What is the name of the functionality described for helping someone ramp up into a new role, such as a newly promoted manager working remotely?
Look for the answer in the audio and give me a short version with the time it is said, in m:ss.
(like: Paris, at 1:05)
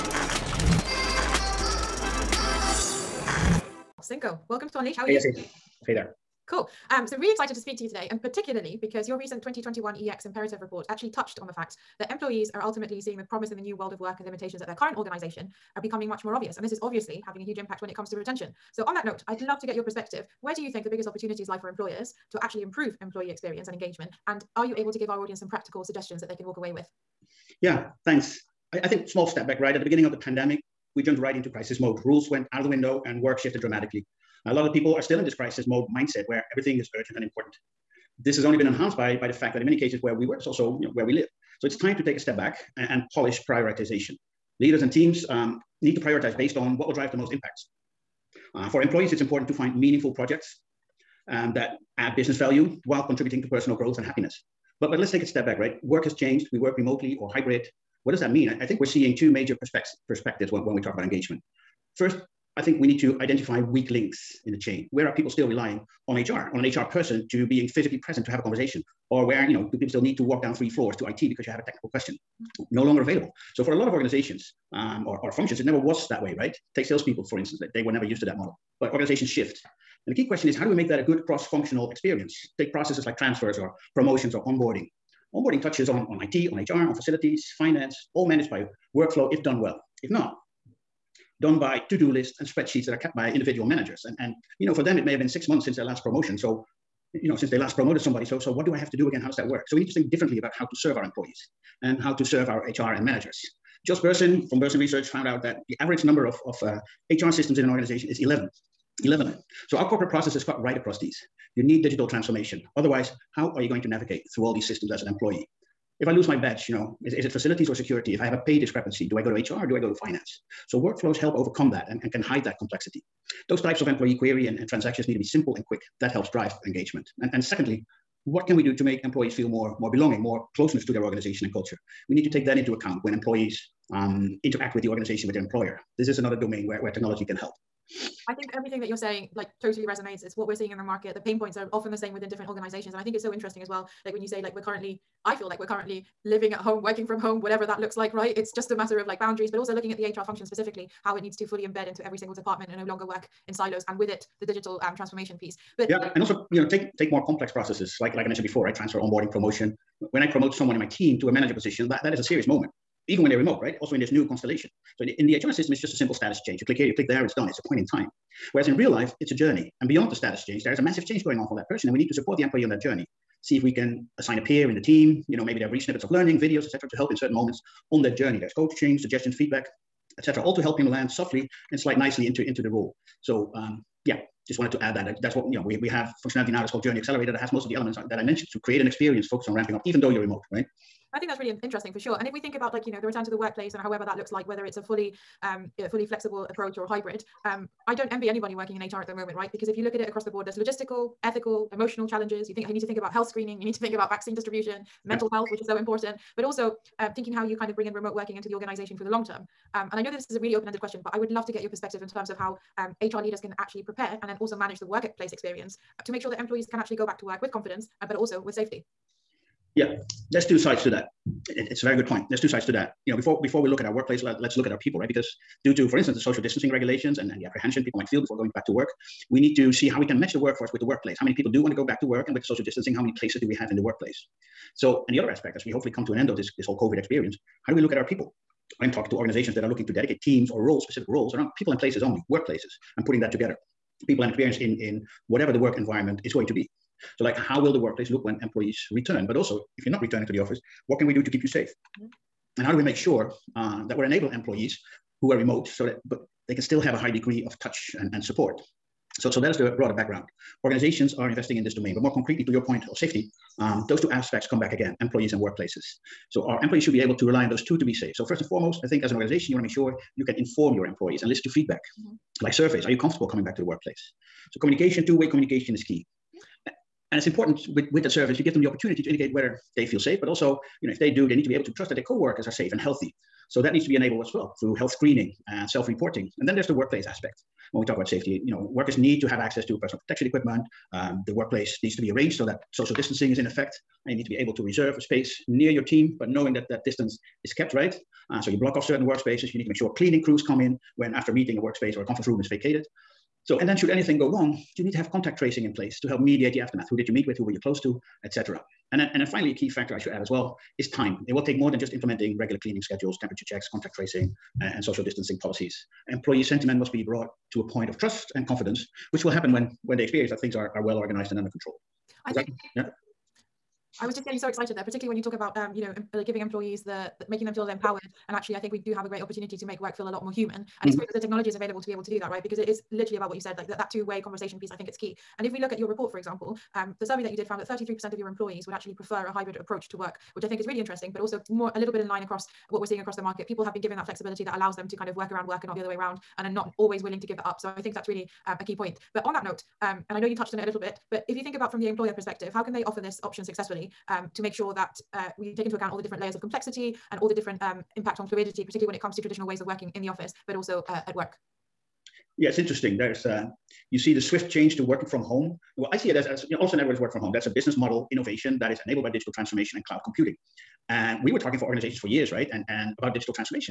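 Journey Accelerator, at 3:06.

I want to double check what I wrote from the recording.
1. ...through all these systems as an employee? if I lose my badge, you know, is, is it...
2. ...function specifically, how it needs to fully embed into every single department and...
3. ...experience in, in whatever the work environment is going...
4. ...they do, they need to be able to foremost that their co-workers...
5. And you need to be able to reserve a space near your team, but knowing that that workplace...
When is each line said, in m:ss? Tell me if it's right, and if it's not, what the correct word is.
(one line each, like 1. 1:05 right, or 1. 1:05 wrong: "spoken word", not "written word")
1. 1:54 right
2. 2:30 right
3. 4:04 right
4. 4:40 wrong: "trust", not "foremost"
5. 4:54 wrong: "distance", not "workplace".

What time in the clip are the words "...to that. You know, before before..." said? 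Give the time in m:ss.
3:42.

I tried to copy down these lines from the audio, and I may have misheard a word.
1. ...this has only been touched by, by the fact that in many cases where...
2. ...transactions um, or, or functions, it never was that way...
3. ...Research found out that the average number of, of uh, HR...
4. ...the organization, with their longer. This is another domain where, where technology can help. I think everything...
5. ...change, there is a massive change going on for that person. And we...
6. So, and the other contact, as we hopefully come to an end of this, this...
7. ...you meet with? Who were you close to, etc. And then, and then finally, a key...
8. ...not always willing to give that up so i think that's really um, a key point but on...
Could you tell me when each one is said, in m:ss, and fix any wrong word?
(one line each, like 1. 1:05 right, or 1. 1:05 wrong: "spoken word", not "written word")
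1. 0:38 wrong: "enhanced", not "touched"
2. 1:13 wrong: "organizations", not "transactions"
3. 1:44 right
4. 2:14 wrong: "employer", not "longer"
5. 2:50 right
6. 3:54 wrong: "aspect", not "contact"
7. 5:07 right
8. 5:46 right.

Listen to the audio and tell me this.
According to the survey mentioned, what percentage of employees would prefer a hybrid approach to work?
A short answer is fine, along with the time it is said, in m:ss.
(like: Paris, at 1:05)
33%, at 5:37.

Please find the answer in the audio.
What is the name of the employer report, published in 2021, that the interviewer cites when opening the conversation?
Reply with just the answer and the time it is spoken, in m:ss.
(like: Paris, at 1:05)
EX Imperative, at 0:09.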